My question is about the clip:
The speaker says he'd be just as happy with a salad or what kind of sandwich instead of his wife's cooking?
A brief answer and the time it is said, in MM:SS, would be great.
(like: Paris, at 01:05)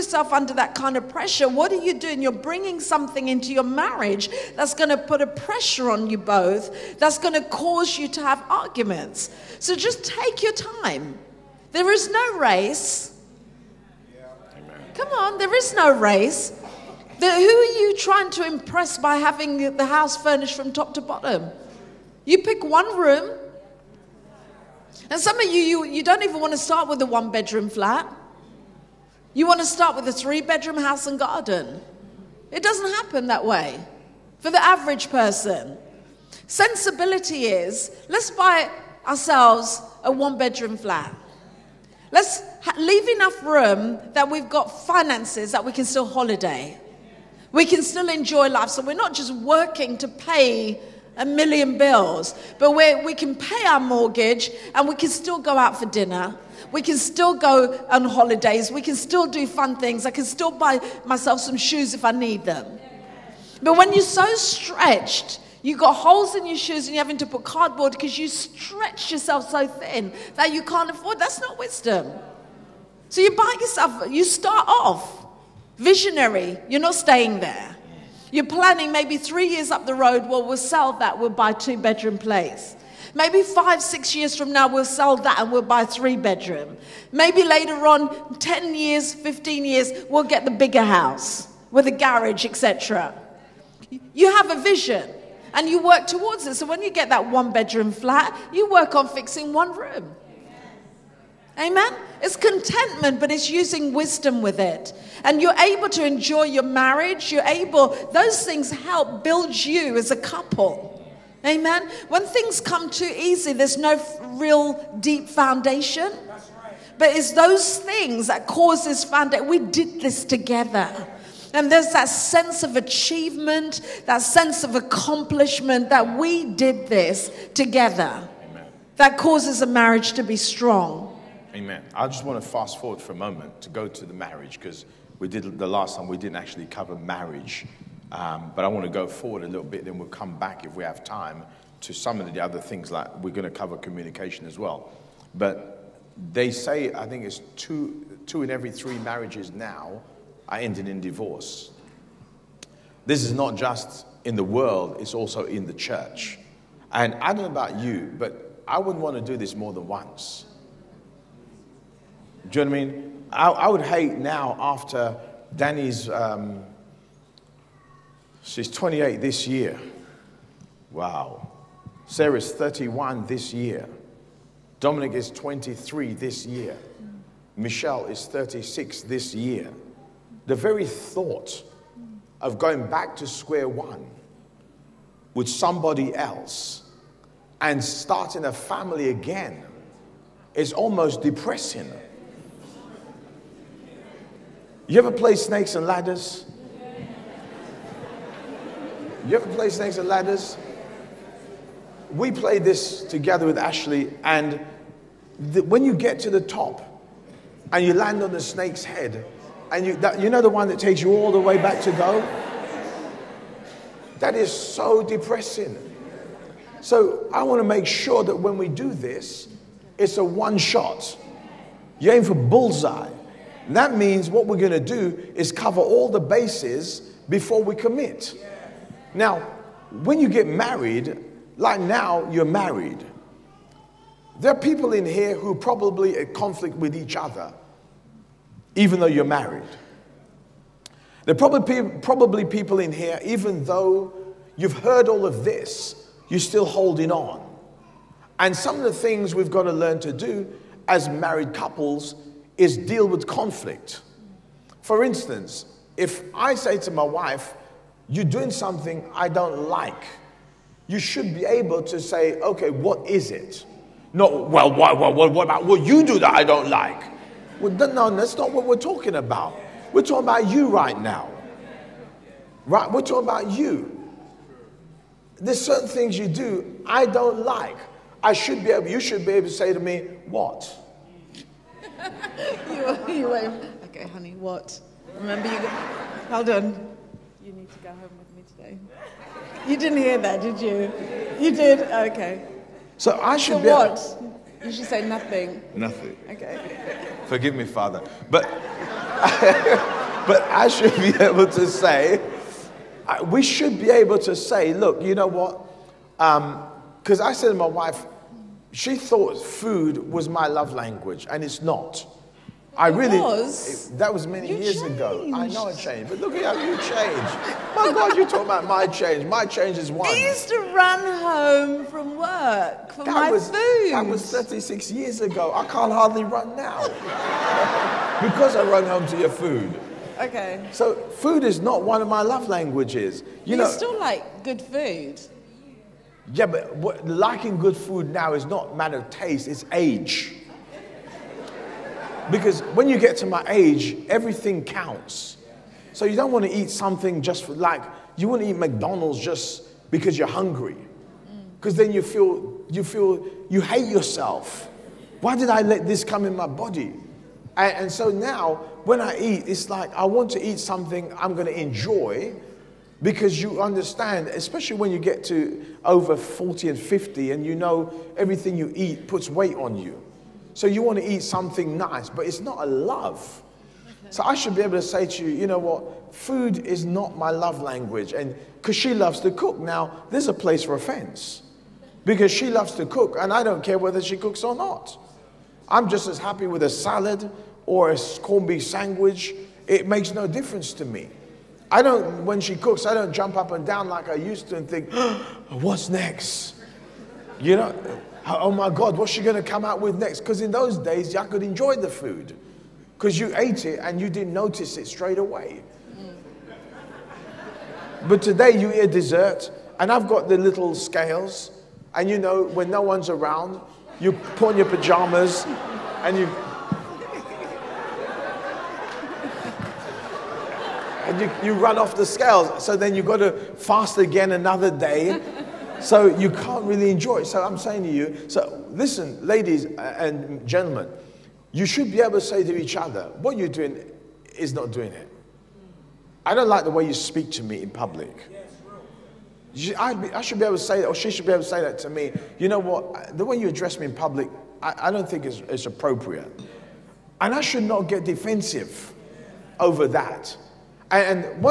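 corned beef, at 06:28.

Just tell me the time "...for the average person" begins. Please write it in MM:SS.
00:34.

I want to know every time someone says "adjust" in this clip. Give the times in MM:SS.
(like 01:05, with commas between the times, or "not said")
not said.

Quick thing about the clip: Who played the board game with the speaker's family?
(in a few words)
Ashley.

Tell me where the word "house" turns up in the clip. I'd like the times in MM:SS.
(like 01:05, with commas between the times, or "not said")
00:19, 00:30, 01:30.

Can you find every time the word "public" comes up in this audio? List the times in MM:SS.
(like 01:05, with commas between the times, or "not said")
07:17, 07:23.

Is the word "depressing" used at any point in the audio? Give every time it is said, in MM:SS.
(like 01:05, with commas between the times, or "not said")
03:11, 03:35.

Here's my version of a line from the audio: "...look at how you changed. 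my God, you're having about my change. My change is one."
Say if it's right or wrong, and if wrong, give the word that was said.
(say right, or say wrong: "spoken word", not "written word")
wrong: "talking", not "having".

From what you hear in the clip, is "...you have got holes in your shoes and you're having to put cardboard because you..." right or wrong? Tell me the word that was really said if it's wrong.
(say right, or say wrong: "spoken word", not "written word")
right.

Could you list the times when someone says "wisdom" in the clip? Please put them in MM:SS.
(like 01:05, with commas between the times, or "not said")
01:11, 01:43.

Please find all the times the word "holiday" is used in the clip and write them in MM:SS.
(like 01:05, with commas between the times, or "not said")
00:46, 00:58.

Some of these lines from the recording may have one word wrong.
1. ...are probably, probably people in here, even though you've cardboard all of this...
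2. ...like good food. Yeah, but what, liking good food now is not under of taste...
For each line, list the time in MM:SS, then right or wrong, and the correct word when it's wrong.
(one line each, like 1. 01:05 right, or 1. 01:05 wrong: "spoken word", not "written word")
1. 04:01 wrong: "heard", not "cardboard"
2. 05:33 wrong: "matter", not "under".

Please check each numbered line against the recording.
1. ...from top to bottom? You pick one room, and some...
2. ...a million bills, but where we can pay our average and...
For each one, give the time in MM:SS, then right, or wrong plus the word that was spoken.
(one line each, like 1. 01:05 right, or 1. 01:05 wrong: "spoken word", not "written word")
1. 00:20 right
2. 00:51 wrong: "mortgage", not "average".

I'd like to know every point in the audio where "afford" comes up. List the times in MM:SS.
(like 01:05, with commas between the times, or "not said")
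01:10.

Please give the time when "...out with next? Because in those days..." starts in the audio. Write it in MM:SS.
06:39.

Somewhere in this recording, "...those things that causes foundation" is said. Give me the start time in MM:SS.
01:57.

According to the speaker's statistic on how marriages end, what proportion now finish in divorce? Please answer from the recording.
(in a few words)
2 in every 3.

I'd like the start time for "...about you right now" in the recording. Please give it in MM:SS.
04:30.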